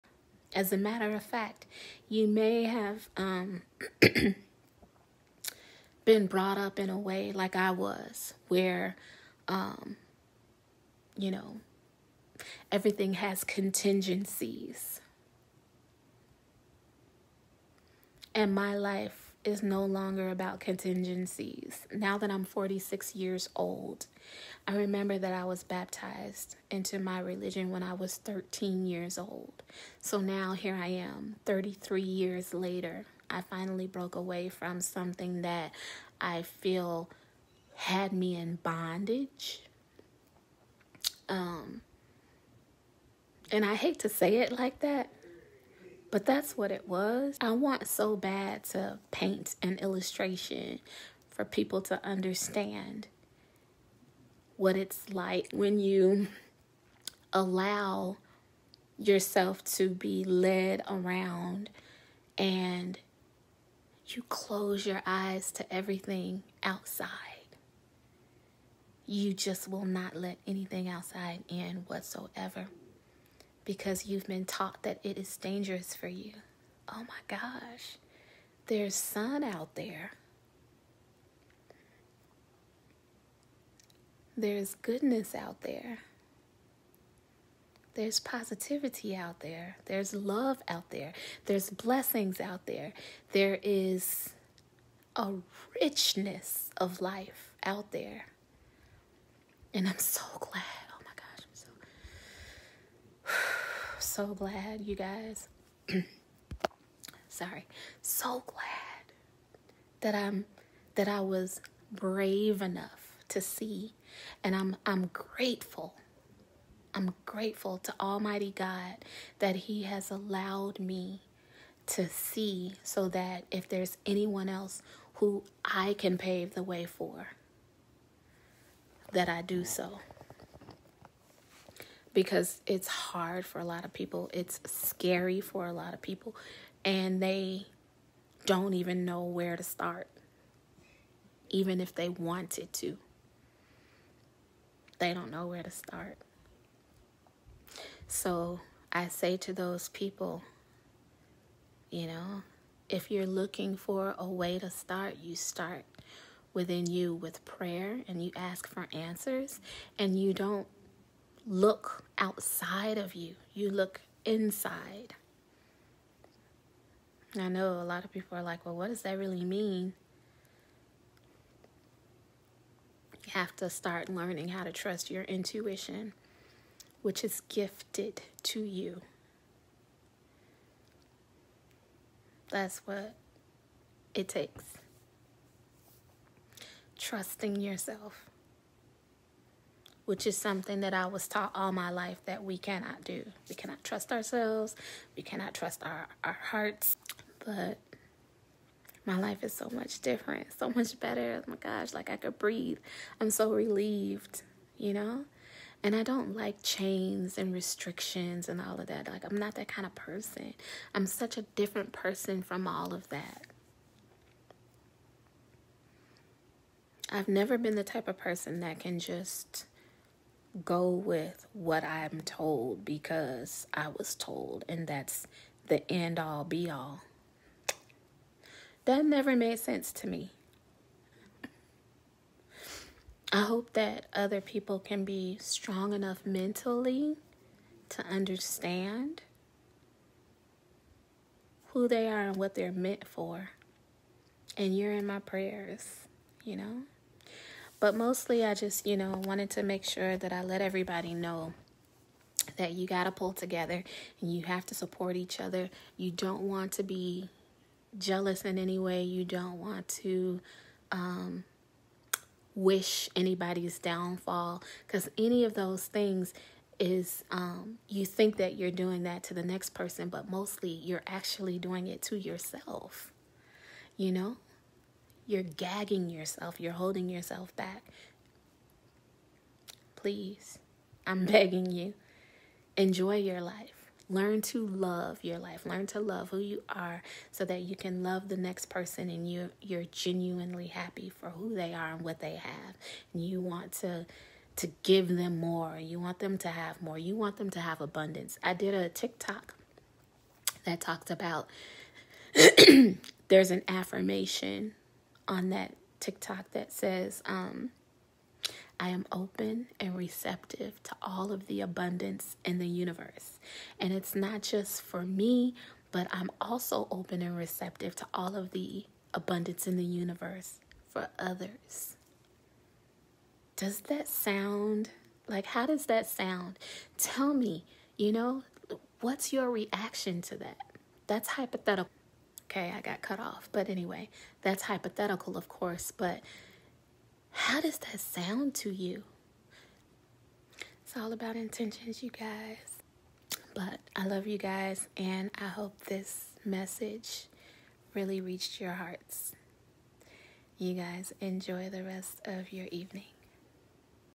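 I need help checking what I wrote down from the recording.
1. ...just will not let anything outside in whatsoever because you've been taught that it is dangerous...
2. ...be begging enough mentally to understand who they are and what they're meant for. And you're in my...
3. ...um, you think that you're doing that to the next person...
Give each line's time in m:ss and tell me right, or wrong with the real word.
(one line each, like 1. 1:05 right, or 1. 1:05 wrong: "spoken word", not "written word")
1. 1:09 right
2. 3:55 wrong: "strong", not "begging"
3. 4:27 right.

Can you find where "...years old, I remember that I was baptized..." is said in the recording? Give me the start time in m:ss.
0:23.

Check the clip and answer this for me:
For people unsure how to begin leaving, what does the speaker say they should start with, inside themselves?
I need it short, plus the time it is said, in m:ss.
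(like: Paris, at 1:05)
Prayer, at 2:37.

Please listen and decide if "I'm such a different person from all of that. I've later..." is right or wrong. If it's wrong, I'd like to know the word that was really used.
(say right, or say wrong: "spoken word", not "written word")
wrong: "never", not "later".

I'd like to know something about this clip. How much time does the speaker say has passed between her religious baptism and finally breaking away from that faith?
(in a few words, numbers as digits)
33 years.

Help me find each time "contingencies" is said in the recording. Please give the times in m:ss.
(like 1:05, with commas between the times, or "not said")
0:13, 0:20.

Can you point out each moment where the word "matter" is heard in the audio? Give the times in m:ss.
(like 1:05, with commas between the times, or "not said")
0:00.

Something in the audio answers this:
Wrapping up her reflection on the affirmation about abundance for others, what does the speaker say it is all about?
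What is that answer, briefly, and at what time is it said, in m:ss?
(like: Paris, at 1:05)
Intentions, at 5:41.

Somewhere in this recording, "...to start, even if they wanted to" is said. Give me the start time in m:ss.
2:19.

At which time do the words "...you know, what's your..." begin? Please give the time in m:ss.
5:27.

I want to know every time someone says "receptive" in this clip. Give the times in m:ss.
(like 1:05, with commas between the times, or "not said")
5:09, 5:17.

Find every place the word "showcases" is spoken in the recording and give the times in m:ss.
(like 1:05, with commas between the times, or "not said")
not said.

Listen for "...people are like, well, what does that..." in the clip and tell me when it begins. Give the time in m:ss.
2:48.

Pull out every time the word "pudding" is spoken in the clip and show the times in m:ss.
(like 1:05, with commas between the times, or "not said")
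not said.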